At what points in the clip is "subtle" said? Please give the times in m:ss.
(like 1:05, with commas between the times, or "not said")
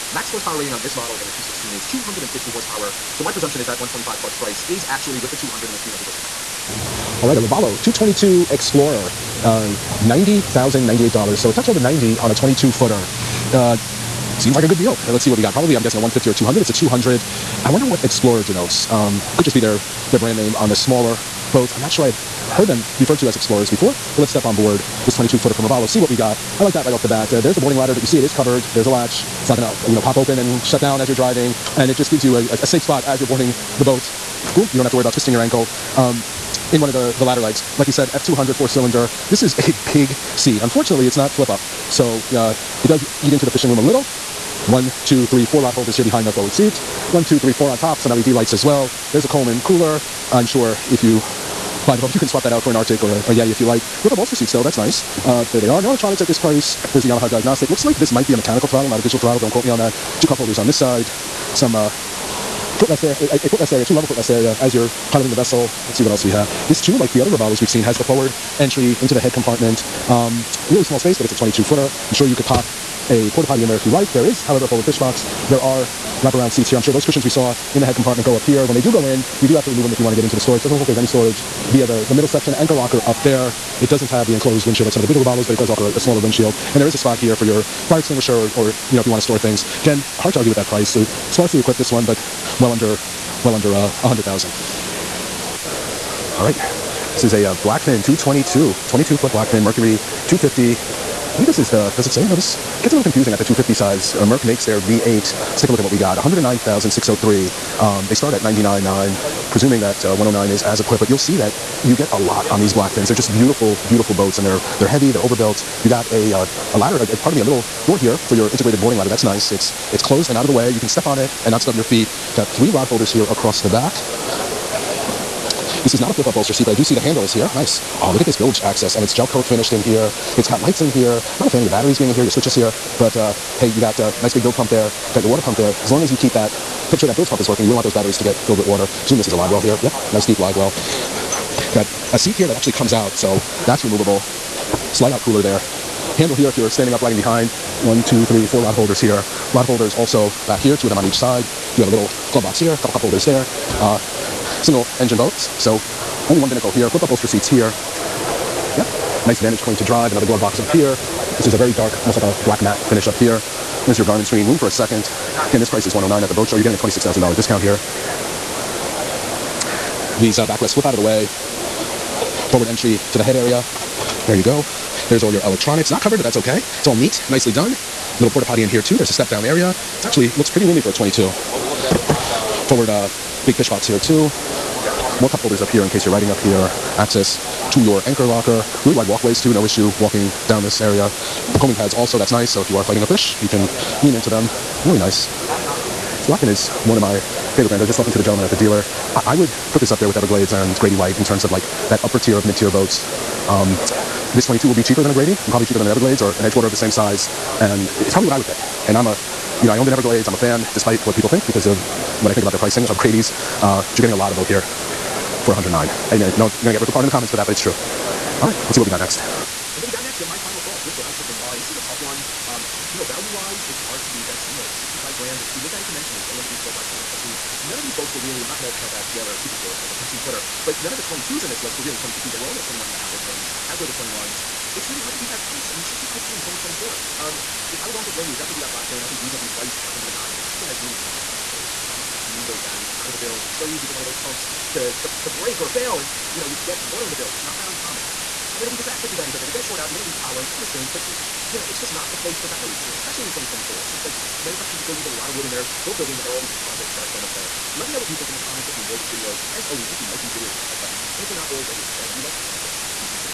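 not said.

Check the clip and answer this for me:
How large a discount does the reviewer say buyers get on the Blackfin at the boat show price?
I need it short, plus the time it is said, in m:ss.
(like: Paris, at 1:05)
$26,000, at 2:46.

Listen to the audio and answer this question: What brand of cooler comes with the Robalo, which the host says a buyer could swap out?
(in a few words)
Coleman.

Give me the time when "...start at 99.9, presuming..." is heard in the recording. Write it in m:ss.
1:48.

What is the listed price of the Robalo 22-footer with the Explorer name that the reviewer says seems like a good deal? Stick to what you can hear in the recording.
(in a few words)
$90,098.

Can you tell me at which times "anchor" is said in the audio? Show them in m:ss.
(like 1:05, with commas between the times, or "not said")
1:22, 3:08.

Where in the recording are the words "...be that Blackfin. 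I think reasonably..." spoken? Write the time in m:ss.
3:58.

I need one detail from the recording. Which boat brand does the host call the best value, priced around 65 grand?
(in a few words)
Stingray.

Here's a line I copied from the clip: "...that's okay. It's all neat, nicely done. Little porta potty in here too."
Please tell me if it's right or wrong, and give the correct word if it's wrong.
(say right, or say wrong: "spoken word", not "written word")
right.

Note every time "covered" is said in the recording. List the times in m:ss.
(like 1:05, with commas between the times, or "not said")
0:28, 2:56.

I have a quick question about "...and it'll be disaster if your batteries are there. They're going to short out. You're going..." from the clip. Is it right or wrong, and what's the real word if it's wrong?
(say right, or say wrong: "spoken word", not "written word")
right.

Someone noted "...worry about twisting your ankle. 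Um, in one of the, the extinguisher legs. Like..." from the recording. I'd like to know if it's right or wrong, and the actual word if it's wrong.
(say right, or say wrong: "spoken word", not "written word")
wrong: "latter", not "extinguisher".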